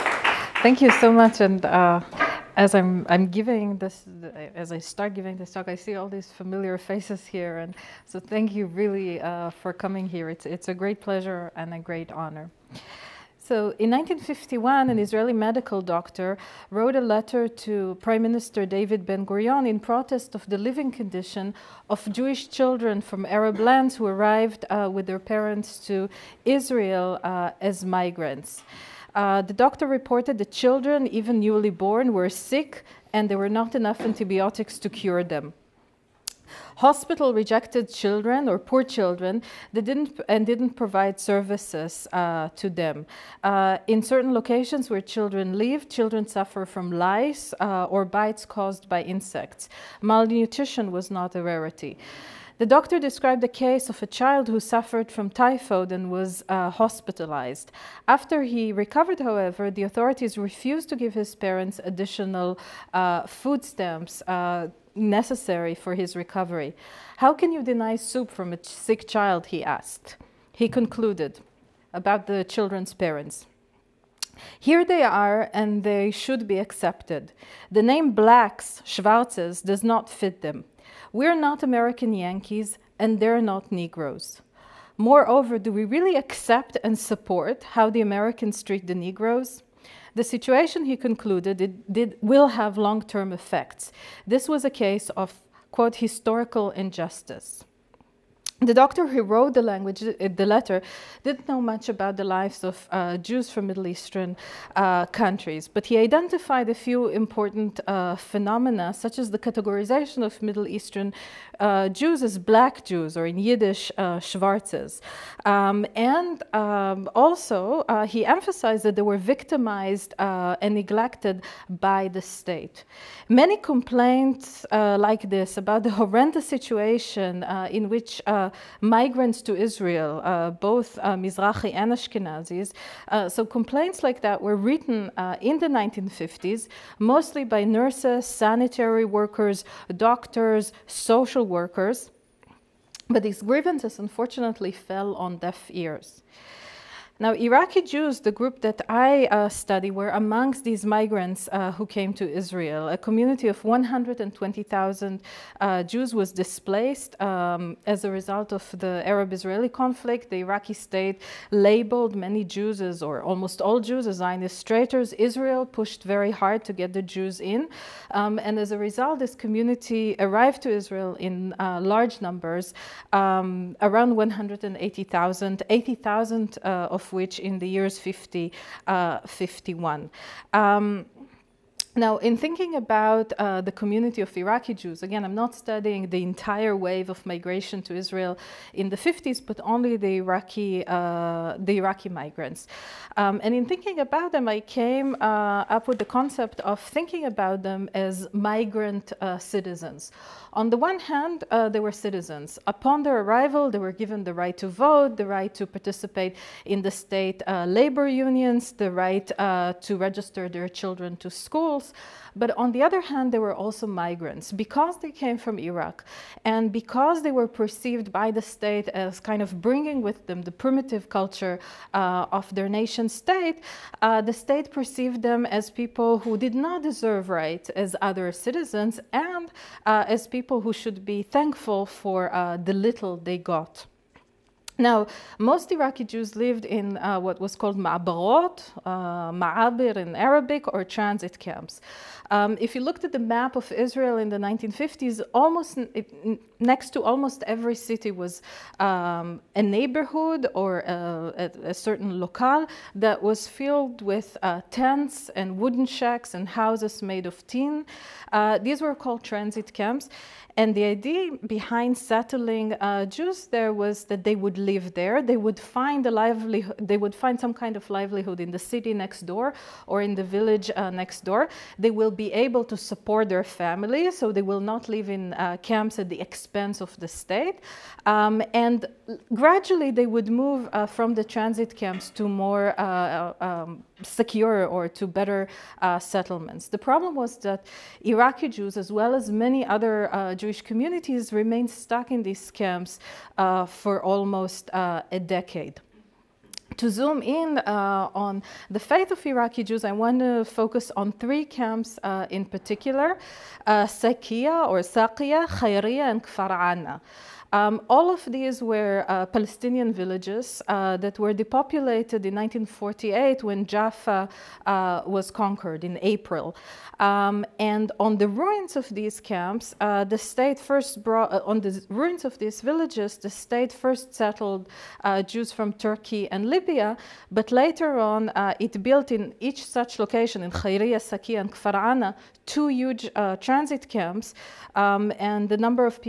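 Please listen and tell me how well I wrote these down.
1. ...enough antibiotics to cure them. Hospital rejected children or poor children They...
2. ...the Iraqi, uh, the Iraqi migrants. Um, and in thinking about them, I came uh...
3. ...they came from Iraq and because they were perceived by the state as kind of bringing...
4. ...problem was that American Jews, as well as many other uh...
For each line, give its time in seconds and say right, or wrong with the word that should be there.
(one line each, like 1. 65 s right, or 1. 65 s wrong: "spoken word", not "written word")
1. 33 s right
2. 189 s right
3. 214 s right
4. 286 s wrong: "Iraqi", not "American".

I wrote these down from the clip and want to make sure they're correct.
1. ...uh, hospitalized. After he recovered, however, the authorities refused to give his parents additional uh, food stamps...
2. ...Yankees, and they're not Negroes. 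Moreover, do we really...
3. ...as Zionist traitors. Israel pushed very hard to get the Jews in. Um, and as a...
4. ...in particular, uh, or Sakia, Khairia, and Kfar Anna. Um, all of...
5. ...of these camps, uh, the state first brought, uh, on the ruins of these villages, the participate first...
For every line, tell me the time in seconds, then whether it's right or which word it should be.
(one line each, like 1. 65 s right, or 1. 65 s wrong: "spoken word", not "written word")
1. 56 s right
2. 82 s right
3. 164 s right
4. 302 s right
5. 318 s wrong: "state", not "participate".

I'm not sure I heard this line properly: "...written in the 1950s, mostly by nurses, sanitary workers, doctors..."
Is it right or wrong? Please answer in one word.
right.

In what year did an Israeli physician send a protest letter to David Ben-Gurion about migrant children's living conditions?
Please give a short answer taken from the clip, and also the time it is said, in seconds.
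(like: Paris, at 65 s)
1951, at 13 s.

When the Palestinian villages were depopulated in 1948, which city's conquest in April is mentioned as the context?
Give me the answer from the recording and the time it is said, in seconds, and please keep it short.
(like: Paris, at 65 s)
Jaffa, at 313 s.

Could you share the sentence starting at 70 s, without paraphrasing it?
He concluded about the children's parents.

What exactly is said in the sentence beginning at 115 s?
Um, and um, also, uh, he emphasized that they were victimized and neglected by the state.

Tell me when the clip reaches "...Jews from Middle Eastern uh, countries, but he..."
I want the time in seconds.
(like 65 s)
103 s.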